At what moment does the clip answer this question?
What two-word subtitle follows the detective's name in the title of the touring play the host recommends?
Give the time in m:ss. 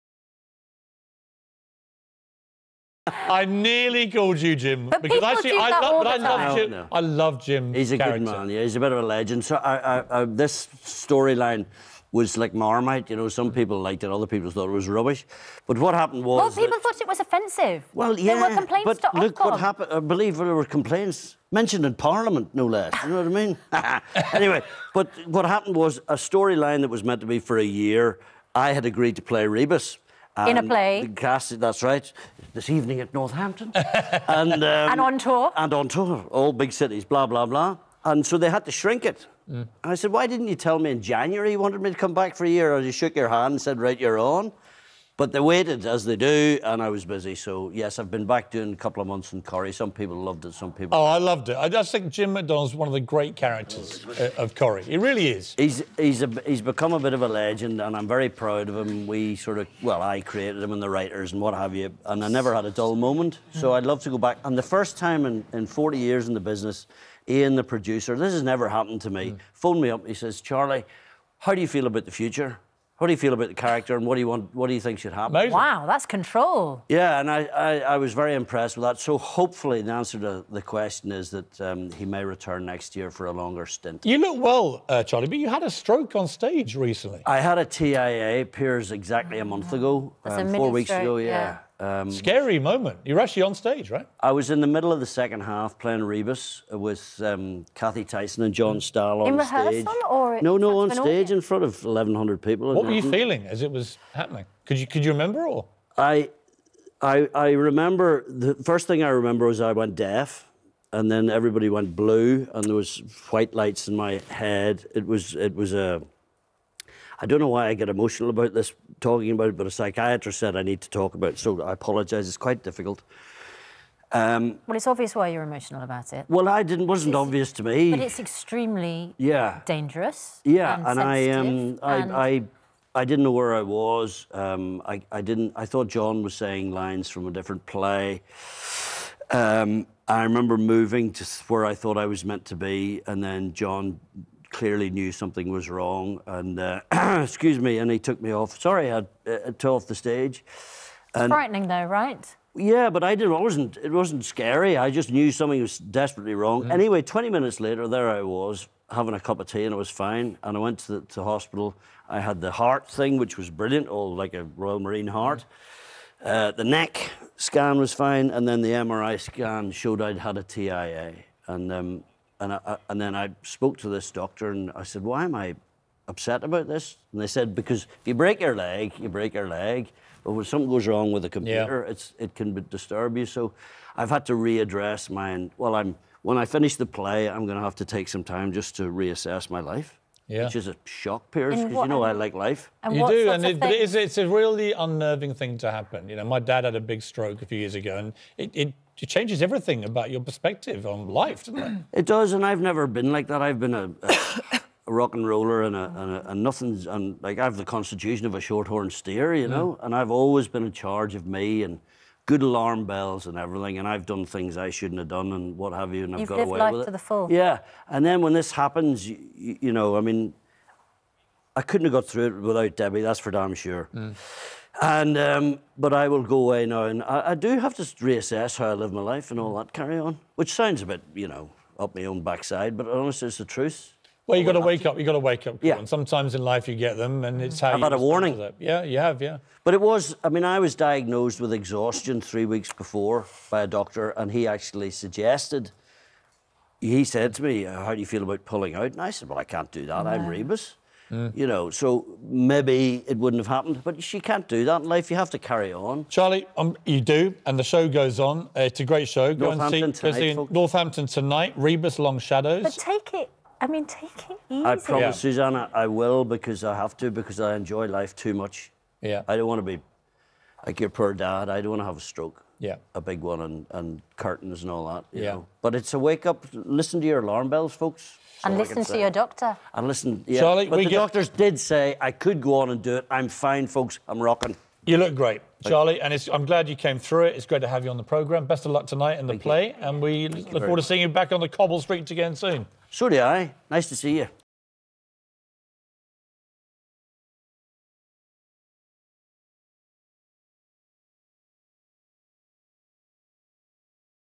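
4:21.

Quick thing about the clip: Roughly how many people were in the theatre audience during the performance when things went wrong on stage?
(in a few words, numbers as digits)
1,100.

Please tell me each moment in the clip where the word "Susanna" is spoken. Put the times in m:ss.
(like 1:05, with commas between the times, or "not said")
4:25.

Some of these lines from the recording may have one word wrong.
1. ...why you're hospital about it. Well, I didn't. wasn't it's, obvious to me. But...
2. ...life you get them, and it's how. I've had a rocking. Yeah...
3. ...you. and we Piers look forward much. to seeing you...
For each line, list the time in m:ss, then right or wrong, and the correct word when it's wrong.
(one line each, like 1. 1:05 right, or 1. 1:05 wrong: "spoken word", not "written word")
1. 2:05 wrong: "emotional", not "hospital"
2. 3:56 wrong: "warning", not "rocking"
3. 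4:49 wrong: "Thank", not "Piers".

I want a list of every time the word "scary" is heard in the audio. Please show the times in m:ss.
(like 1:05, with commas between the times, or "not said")
1:32, 2:34.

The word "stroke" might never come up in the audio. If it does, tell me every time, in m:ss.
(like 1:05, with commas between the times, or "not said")
1:25, 1:30, 3:17, 4:32.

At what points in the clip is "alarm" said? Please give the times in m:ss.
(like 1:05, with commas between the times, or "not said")
3:32, 4:37.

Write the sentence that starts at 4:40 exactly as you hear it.
doctors did say I could go on and do it.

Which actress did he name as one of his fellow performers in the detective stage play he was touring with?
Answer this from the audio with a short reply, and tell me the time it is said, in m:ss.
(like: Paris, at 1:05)
Cathy Tyson, at 1:37.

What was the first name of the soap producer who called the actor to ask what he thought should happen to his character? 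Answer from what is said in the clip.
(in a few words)
Ian.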